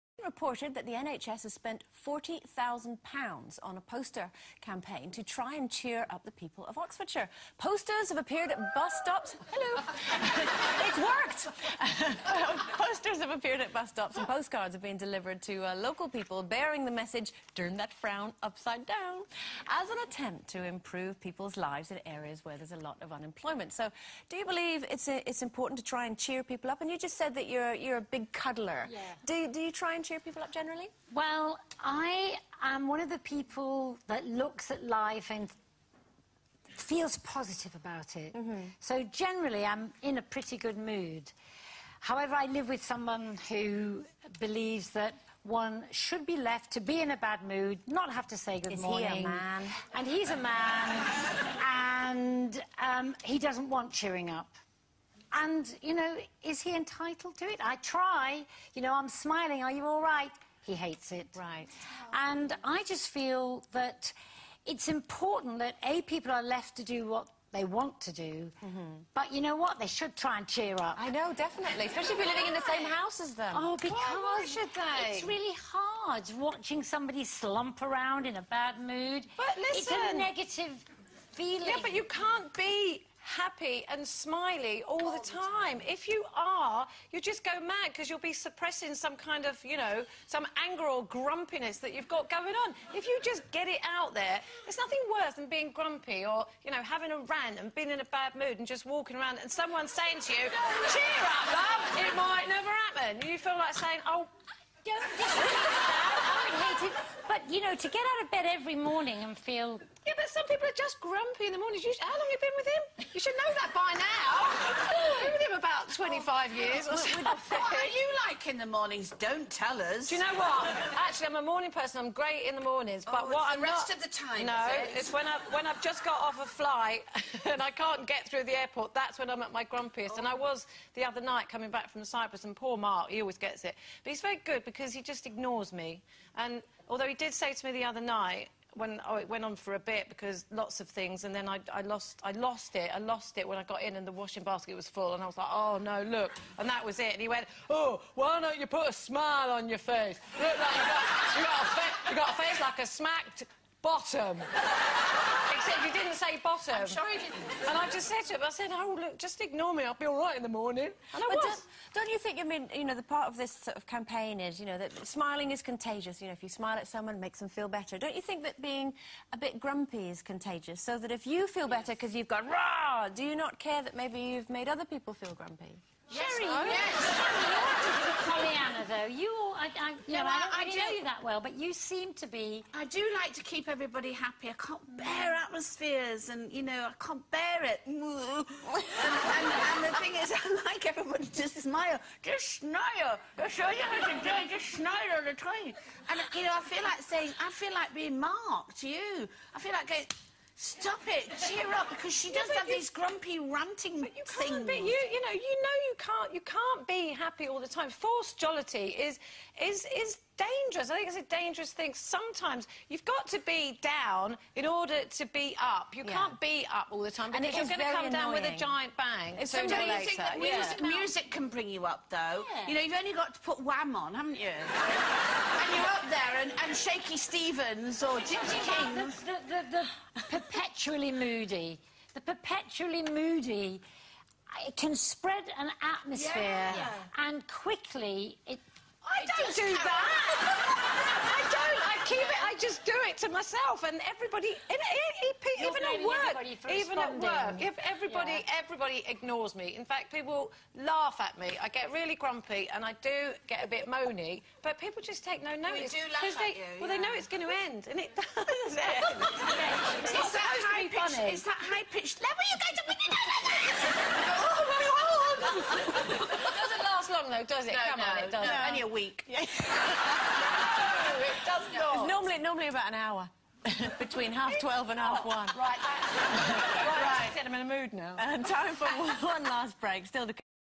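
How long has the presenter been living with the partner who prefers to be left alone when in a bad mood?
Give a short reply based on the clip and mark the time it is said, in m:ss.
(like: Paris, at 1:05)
25 years, at 1:56.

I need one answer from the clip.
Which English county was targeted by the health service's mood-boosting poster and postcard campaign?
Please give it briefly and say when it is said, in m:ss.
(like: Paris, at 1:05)
Oxfordshire, at 0:06.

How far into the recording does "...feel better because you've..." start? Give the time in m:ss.
2:51.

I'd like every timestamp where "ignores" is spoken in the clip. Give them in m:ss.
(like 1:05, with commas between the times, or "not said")
2:15, 2:39, 4:09.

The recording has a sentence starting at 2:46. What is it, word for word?
You know, if you smile at someone, it makes them feel better.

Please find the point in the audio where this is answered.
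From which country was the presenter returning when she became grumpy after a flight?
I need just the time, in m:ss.
2:12.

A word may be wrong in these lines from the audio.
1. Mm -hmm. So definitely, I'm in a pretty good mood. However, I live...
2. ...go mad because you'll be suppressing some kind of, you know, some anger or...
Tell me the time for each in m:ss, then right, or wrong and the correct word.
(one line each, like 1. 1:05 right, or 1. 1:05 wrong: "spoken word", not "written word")
1. 0:38 wrong: "generally", not "definitely"
2. 1:27 right.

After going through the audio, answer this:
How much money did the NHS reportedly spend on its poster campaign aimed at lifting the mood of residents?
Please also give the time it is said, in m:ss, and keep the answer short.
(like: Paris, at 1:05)
£40,000, at 0:02.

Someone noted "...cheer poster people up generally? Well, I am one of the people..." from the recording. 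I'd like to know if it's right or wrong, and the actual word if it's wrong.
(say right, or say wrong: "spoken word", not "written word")
wrong: "cheer", not "poster".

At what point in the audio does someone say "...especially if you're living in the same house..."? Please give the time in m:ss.
1:11.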